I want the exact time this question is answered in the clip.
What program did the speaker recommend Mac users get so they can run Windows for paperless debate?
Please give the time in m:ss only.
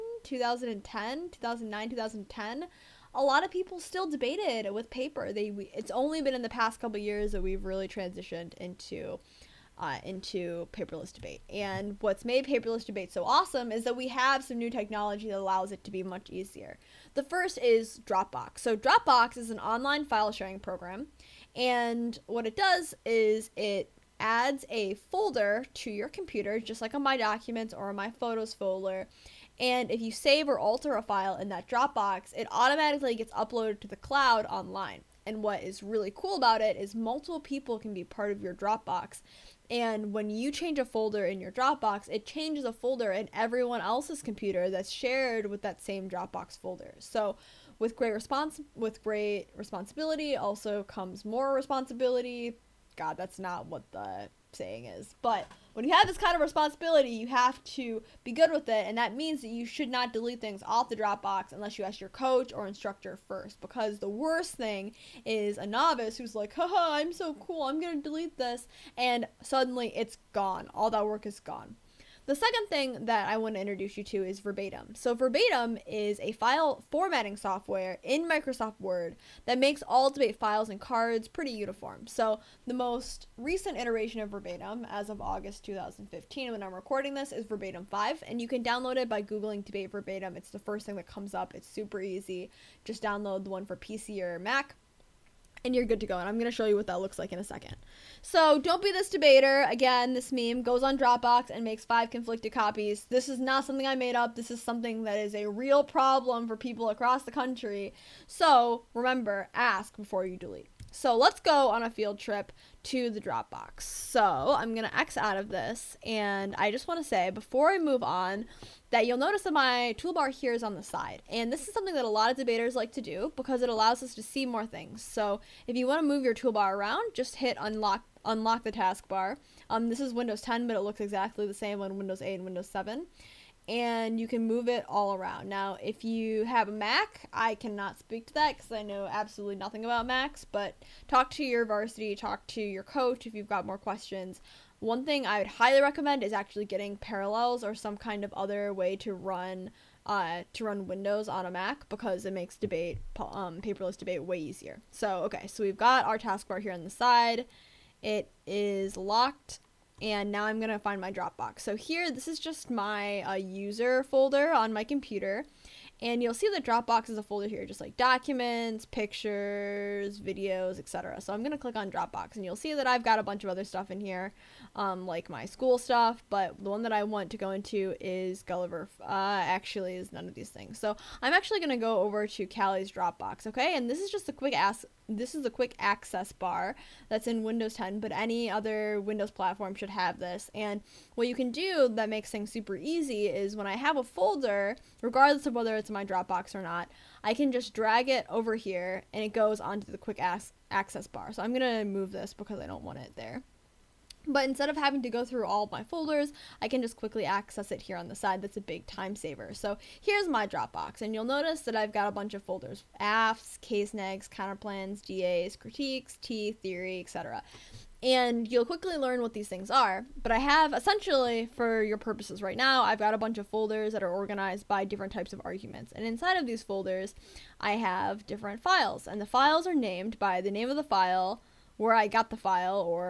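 2:26.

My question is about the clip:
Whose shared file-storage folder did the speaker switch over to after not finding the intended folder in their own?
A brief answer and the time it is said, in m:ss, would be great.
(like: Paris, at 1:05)
Callie's, at 3:02.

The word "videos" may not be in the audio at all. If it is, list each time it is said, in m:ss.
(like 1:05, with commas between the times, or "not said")
2:50.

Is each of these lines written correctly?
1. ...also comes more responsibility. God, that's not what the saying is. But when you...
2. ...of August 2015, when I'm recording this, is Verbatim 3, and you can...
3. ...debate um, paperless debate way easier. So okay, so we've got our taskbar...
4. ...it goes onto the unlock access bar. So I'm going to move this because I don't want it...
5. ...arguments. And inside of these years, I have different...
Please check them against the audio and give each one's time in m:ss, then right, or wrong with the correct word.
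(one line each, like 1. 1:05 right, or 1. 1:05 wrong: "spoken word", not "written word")
1. 0:50 right
2. 1:25 wrong: "5", not "3"
3. 2:32 right
4. 3:19 wrong: "quick", not "unlock"
5. 3:45 wrong: "folders", not "years".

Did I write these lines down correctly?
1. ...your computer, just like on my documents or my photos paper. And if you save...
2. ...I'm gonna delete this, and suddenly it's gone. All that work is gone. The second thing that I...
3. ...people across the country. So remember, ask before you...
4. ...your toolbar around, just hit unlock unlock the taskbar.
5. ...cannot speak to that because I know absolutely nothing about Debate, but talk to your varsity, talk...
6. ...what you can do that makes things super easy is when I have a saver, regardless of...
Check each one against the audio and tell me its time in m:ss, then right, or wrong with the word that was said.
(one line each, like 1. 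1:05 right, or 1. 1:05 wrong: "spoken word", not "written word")
1. 0:25 wrong: "folder", not "paper"
2. 1:07 right
3. 1:46 right
4. 2:06 right
5. 2:17 wrong: "Macs", not "Debate"
6. 3:11 wrong: "folder", not "saver".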